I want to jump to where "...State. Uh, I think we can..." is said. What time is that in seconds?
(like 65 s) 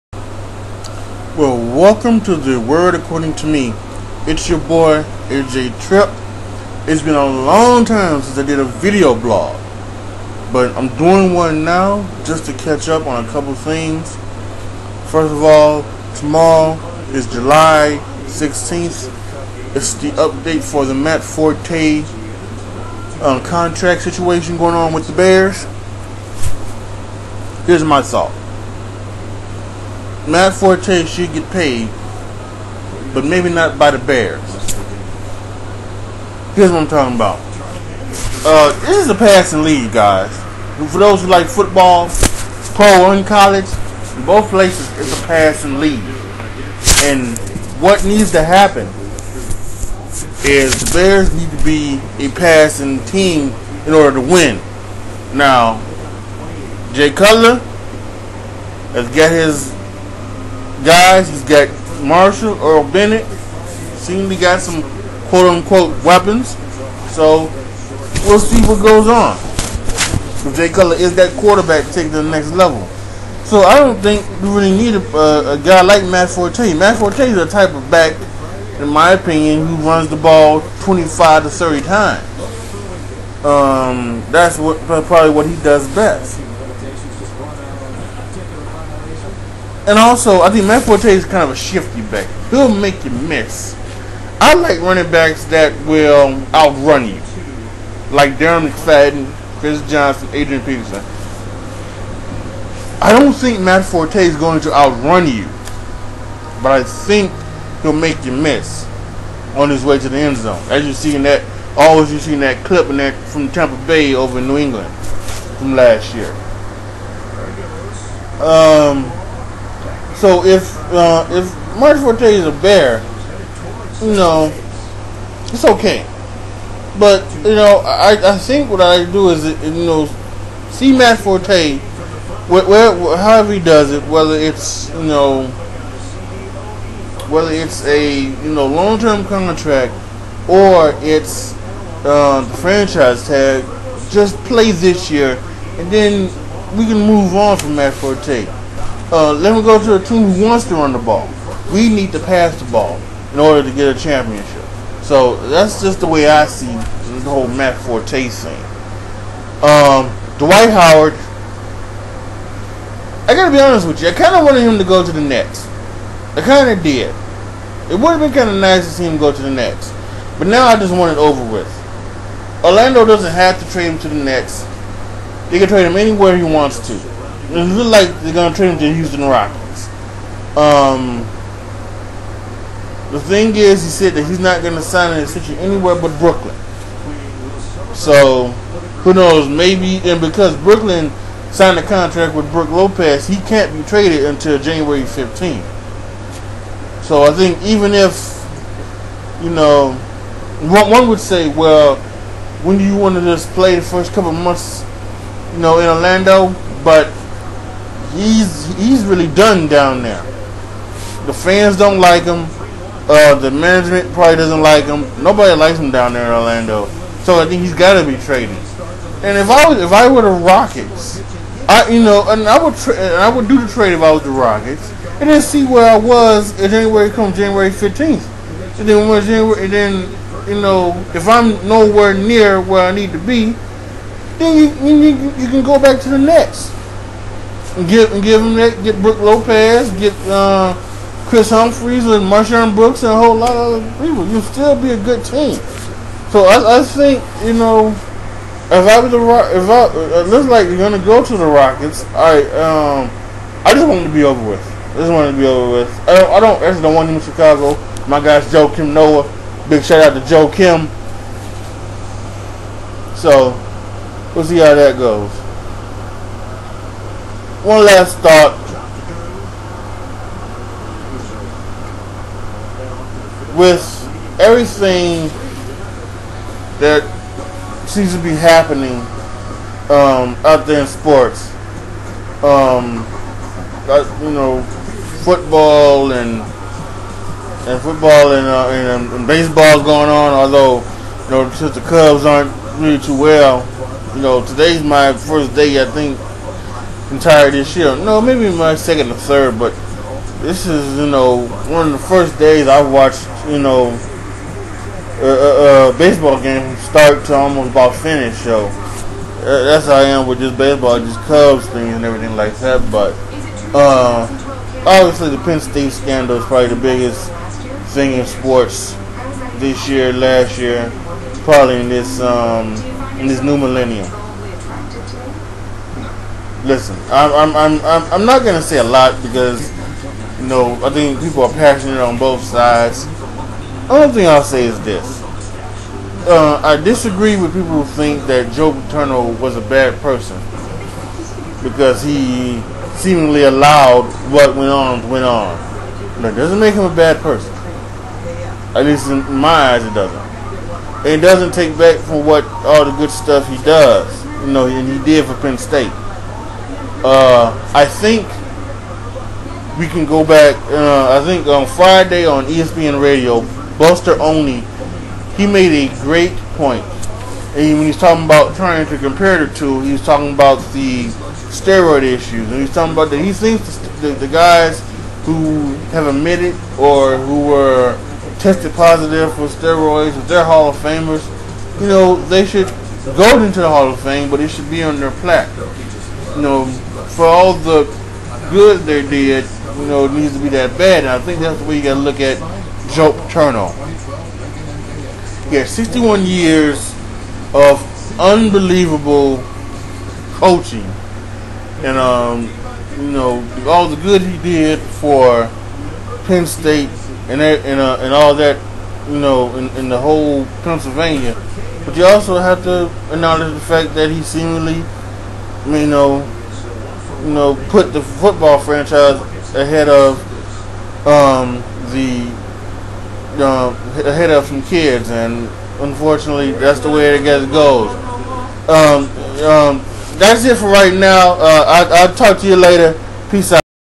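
355 s.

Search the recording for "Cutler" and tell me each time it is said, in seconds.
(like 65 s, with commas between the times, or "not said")
57 s, 70 s.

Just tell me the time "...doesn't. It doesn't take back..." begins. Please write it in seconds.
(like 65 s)
349 s.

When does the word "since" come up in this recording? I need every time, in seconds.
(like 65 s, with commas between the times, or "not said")
8 s, 291 s.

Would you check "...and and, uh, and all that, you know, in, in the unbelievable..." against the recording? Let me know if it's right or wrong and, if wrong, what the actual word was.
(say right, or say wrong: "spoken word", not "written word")
wrong: "whole", not "unbelievable".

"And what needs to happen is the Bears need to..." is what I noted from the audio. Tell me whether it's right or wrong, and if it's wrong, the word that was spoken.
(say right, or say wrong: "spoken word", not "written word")
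right.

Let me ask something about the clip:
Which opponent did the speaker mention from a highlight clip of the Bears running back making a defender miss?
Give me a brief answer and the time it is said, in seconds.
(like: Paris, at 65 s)
Tampa Bay, at 113 s.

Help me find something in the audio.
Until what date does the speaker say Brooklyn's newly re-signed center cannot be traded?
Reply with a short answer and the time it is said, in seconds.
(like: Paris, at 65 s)
January 15th, at 194 s.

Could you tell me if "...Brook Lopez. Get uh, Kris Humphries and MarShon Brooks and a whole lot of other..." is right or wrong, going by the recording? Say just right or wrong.
right.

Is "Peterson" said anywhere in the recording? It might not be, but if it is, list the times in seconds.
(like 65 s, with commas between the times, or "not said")
100 s.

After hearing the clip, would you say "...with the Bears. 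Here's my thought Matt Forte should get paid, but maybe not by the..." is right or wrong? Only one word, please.
right.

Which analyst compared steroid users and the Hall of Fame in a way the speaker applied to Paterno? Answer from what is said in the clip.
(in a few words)
Buster Olney.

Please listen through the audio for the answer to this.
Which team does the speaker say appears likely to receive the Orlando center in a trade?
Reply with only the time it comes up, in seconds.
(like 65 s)
178 s.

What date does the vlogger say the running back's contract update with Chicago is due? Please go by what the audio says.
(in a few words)
July 16th.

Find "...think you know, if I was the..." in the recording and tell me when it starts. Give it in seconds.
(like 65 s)
246 s.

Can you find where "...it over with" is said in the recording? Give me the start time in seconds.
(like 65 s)
171 s.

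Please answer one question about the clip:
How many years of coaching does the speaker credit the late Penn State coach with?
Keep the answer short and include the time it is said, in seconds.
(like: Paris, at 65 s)
61, at 395 s.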